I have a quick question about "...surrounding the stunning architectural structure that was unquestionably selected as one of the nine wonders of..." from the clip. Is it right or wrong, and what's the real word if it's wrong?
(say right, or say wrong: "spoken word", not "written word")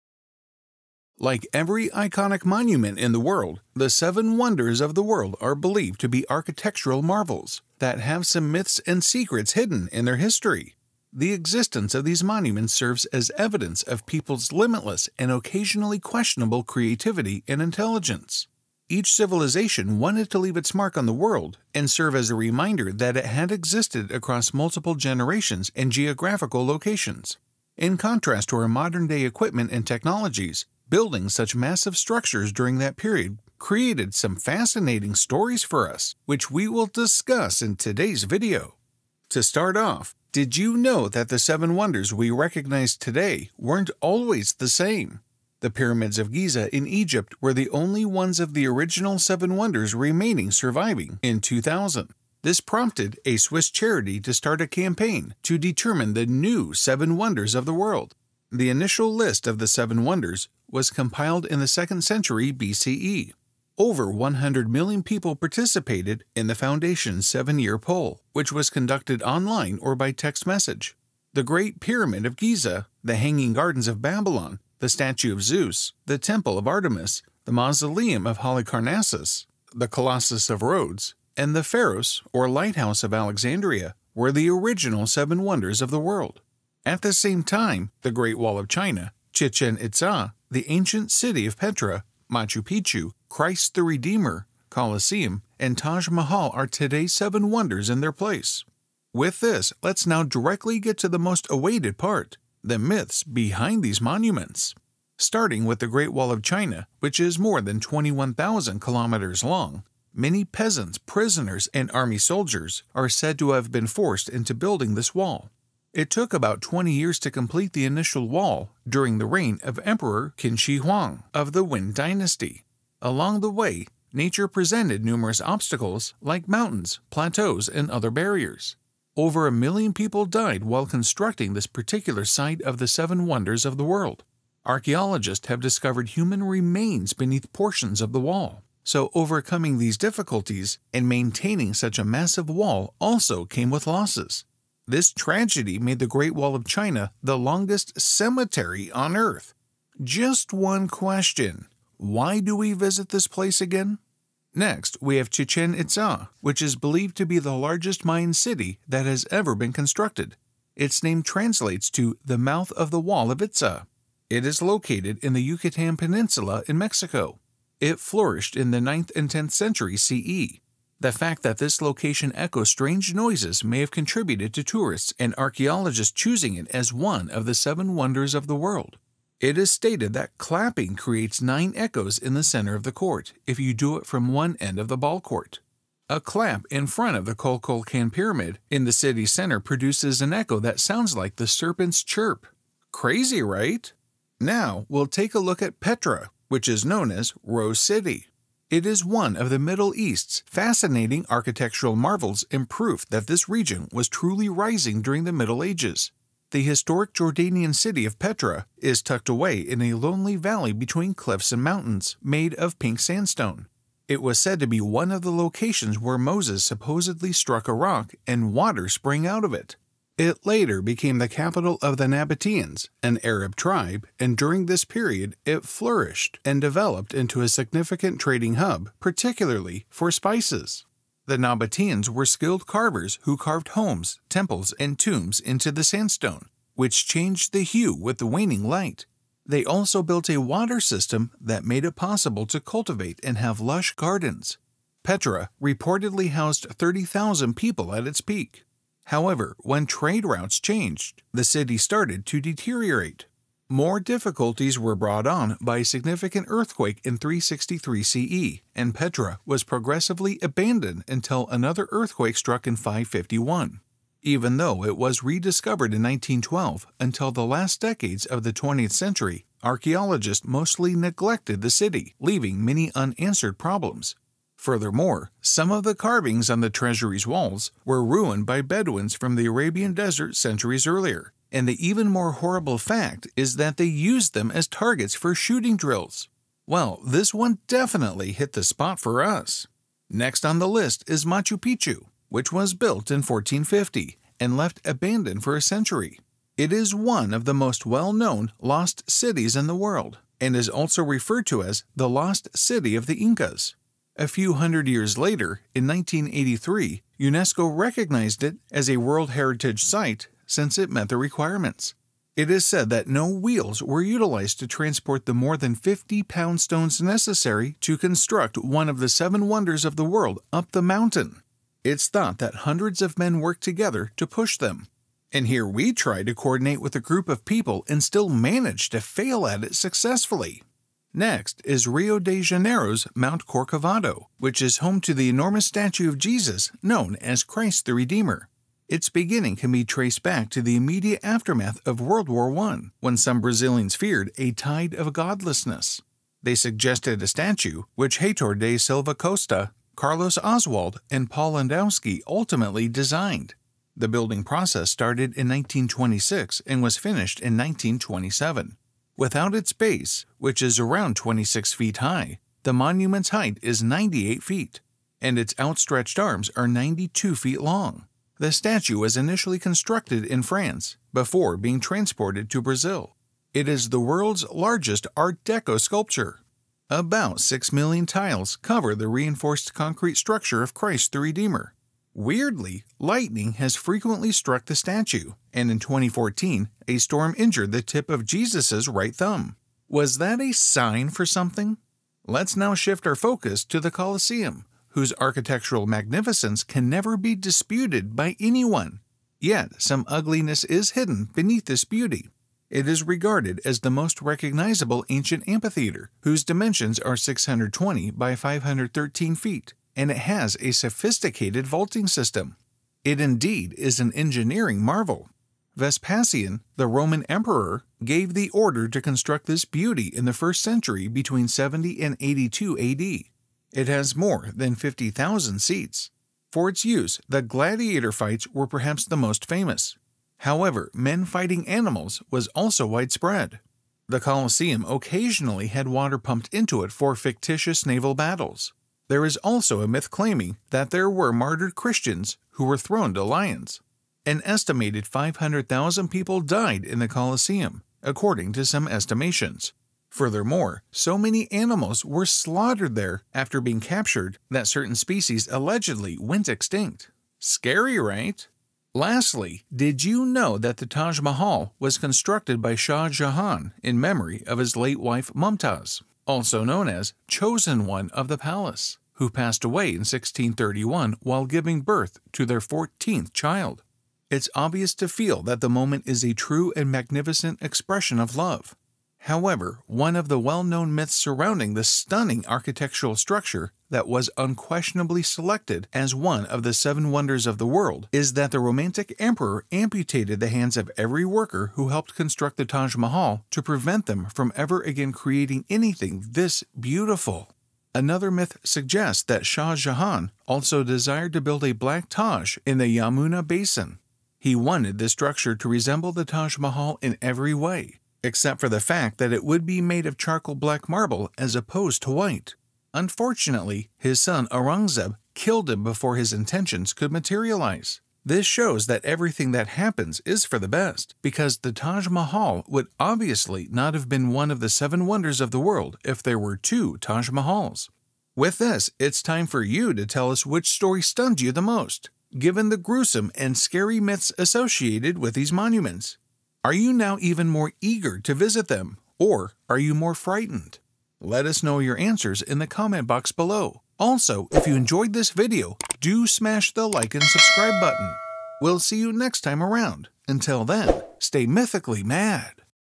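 wrong: "seven", not "nine".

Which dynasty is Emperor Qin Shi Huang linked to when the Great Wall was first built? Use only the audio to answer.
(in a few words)
Wen Dynasty.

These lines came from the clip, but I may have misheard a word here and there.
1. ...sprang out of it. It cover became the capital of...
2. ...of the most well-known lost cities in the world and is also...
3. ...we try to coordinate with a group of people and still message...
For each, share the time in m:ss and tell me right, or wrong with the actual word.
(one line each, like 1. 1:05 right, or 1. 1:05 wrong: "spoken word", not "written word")
1. 3:38 wrong: "later", not "cover"
2. 4:57 right
3. 5:25 wrong: "manage", not "message".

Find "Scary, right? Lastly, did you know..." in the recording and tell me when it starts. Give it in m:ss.
7:37.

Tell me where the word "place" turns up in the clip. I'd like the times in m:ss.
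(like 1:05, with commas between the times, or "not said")
1:38, 2:33.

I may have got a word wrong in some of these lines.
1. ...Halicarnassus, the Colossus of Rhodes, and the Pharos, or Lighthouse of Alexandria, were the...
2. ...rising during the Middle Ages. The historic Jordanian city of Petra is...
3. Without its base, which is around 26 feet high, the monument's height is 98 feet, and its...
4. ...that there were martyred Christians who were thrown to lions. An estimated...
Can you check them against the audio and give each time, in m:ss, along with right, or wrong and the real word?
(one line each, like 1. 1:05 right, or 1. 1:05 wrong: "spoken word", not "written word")
1. 1:18 right
2. 3:24 right
3. 5:59 right
4. 7:20 right.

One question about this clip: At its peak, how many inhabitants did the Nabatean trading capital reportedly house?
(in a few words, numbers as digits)
30,000.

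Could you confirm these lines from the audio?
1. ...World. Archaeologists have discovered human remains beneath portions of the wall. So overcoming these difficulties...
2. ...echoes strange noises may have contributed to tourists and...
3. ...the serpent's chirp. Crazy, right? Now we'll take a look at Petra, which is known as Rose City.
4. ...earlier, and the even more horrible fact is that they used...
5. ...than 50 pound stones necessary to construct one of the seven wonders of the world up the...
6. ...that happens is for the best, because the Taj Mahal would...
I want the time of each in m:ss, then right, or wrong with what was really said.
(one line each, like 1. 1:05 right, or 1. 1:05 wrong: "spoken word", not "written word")
1. 2:13 right
2. 2:52 right
3. 3:11 right
4. 4:40 right
5. 5:15 right
6. 8:39 right.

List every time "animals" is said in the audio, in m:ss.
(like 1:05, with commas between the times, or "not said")
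7:11, 7:31.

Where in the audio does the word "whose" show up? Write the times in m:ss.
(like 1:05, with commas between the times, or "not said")
6:34, 6:46.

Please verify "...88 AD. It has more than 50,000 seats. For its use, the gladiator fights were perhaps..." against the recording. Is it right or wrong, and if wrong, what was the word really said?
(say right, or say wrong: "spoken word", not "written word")
wrong: "82", not "88".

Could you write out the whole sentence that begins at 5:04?
A few hundred years later, in 1983, UNESCO recognized it as a World Heritage Site since it met the requirements.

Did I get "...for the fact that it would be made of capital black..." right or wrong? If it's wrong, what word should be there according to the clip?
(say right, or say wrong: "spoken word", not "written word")
wrong: "charcoal", not "capital".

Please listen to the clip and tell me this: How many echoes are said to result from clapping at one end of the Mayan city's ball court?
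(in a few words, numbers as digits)
9.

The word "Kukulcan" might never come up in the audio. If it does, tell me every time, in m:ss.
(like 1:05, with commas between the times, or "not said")
3:07.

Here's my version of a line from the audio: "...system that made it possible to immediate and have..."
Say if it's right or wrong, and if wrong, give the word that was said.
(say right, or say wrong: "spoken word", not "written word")
wrong: "cultivate", not "immediate".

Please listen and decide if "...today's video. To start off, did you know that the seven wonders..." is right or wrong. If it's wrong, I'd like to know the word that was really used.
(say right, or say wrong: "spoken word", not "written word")
right.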